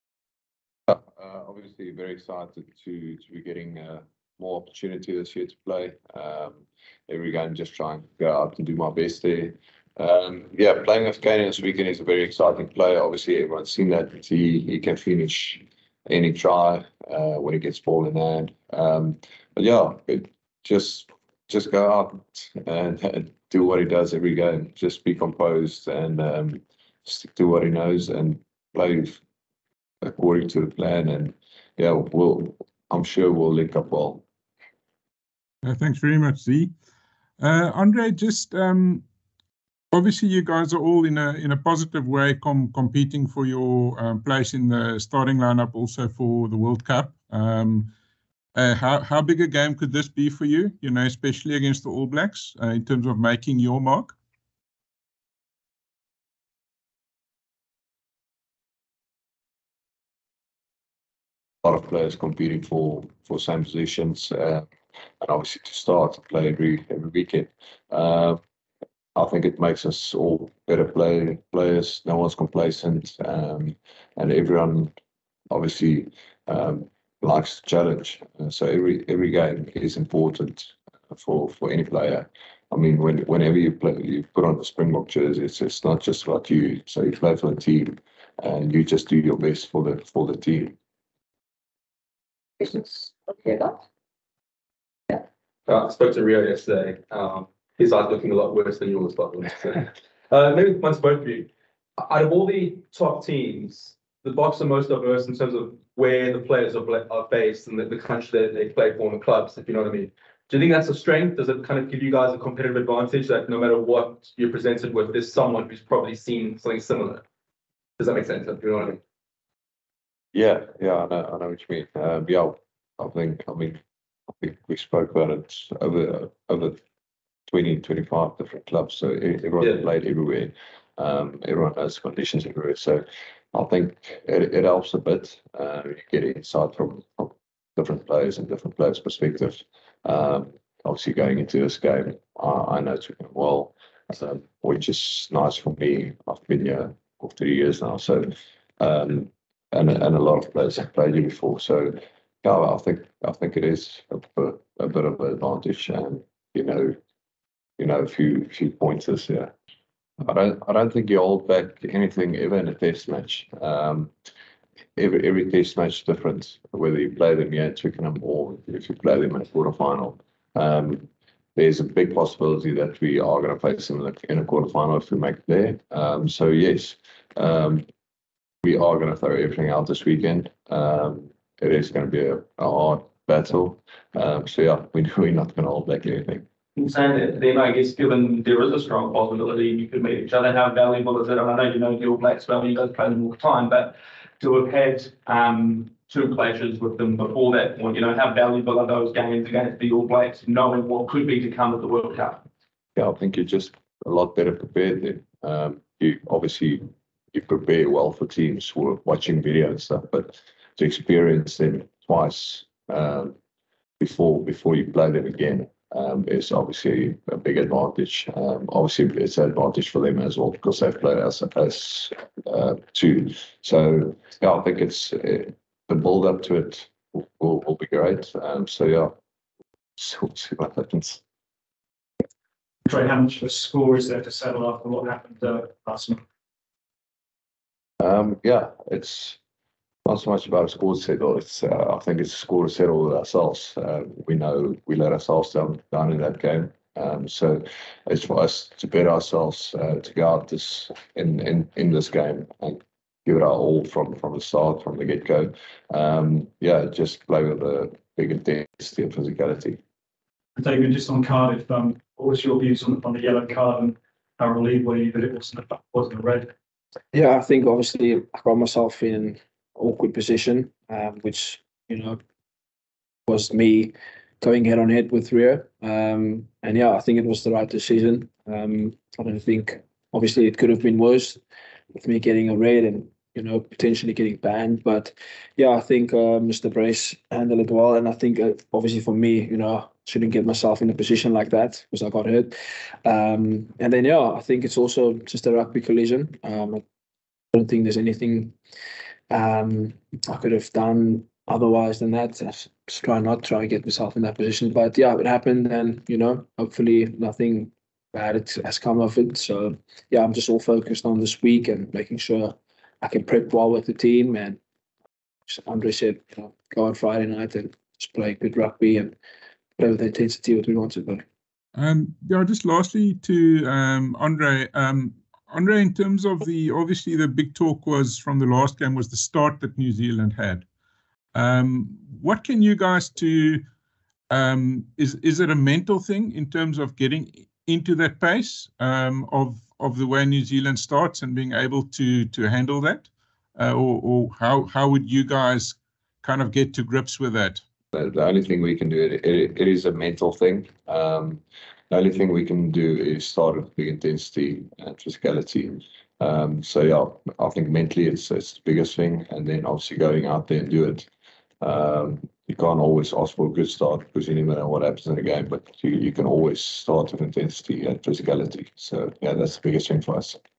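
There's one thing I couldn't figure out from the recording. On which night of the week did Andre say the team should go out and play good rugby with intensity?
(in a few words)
Friday.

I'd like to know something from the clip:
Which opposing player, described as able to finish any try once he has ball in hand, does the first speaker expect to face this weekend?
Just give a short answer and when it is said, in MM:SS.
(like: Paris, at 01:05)
Kane, at 00:11.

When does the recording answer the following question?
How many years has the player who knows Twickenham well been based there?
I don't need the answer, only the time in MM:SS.
02:27.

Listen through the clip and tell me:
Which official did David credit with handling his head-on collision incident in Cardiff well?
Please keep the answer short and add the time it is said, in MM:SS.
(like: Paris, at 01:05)
Mr. Brace, at 04:46.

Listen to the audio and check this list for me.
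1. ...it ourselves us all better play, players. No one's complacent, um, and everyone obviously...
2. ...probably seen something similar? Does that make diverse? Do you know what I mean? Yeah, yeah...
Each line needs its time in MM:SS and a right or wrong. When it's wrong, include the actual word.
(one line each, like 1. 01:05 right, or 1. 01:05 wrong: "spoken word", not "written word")
1. 01:09 wrong: "makes", not "ourselves"
2. 01:55 wrong: "sense", not "diverse".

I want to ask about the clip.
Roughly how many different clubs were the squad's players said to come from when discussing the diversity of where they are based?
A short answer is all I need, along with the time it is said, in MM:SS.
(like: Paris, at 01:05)
25, at 02:07.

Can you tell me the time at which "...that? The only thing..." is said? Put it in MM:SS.
05:47.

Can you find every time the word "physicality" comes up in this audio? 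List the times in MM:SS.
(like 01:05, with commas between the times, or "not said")
04:19, 05:54, 06:08.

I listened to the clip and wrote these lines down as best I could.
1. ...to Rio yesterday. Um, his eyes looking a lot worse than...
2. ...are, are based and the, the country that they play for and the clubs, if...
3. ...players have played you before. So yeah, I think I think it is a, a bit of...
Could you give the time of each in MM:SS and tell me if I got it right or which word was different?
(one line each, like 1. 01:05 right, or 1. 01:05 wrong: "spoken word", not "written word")
1. 01:36 right
2. 01:46 right
3. 02:30 right.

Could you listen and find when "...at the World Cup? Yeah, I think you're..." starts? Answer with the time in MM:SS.
03:21.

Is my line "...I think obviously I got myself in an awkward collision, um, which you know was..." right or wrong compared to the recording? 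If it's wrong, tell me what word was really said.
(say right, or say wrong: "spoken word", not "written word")
wrong: "position", not "collision".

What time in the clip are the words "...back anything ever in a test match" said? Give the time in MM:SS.
02:41.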